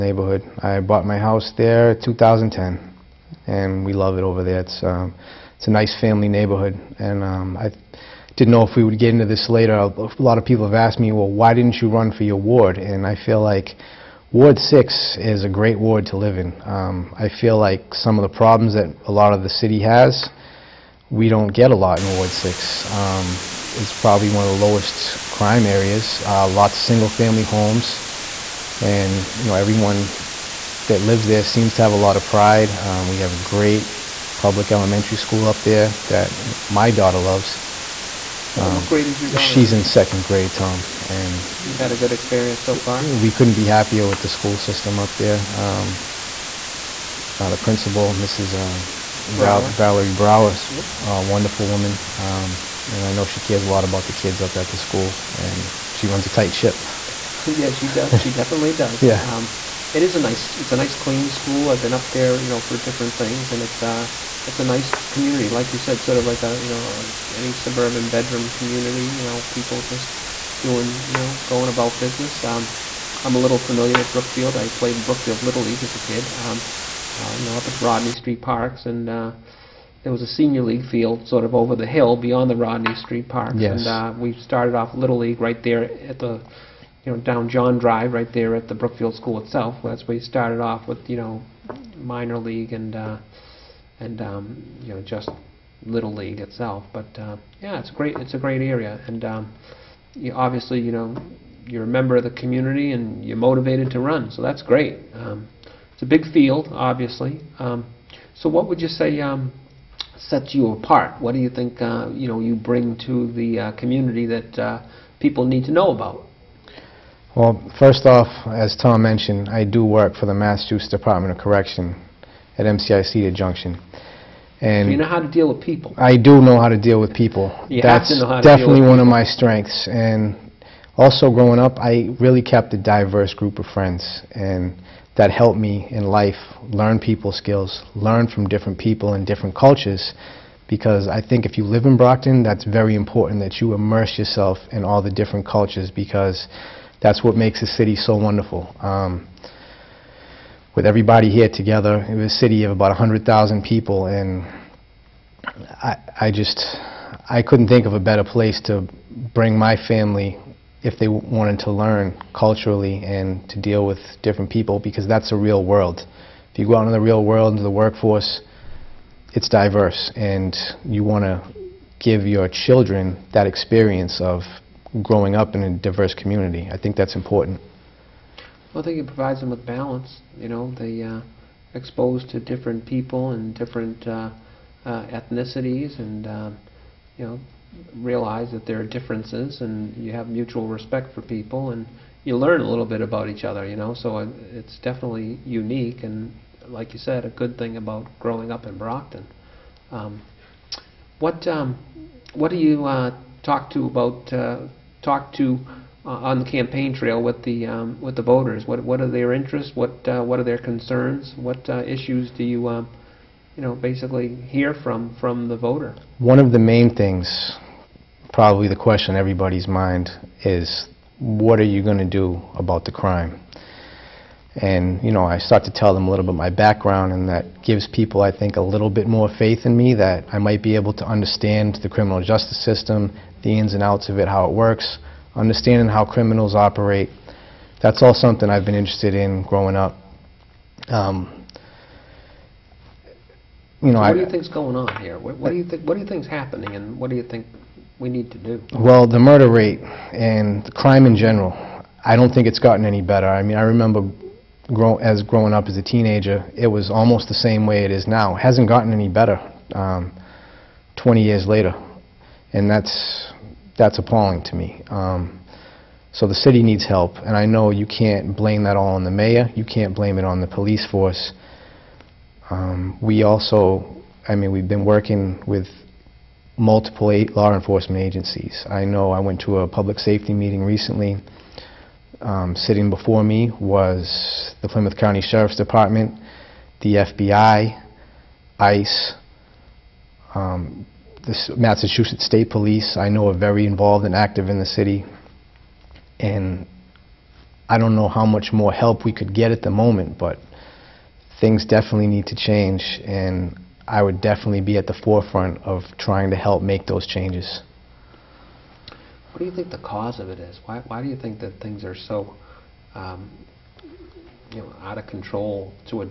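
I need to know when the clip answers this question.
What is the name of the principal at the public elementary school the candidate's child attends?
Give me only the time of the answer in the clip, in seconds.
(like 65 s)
49 s.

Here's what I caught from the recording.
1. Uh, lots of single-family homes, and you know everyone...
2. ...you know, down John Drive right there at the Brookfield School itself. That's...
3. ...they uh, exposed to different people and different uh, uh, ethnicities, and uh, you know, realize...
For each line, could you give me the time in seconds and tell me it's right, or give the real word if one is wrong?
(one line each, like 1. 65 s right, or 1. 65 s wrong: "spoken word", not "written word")
1. 26 s right
2. 87 s right
3. 180 s right.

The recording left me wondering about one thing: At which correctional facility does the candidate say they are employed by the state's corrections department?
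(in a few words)
MCI Cedar Junction.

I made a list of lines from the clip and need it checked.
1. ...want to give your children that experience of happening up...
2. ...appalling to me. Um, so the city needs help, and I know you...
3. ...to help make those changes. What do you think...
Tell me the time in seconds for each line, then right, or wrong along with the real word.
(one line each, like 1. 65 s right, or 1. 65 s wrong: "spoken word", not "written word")
1. 171 s wrong: "growing", not "happening"
2. 263 s right
3. 306 s right.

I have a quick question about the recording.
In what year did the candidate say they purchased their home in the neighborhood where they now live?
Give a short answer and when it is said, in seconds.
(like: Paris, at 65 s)
2010, at 1 s.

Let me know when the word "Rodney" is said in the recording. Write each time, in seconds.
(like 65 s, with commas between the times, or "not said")
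77 s, 82 s.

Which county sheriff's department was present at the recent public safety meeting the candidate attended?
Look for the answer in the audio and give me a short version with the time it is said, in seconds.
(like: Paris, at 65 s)
Plymouth County, at 284 s.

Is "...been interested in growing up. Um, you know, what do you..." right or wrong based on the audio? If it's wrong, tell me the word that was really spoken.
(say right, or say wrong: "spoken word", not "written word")
right.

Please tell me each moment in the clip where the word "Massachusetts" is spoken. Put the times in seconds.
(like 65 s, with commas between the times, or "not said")
120 s, 291 s.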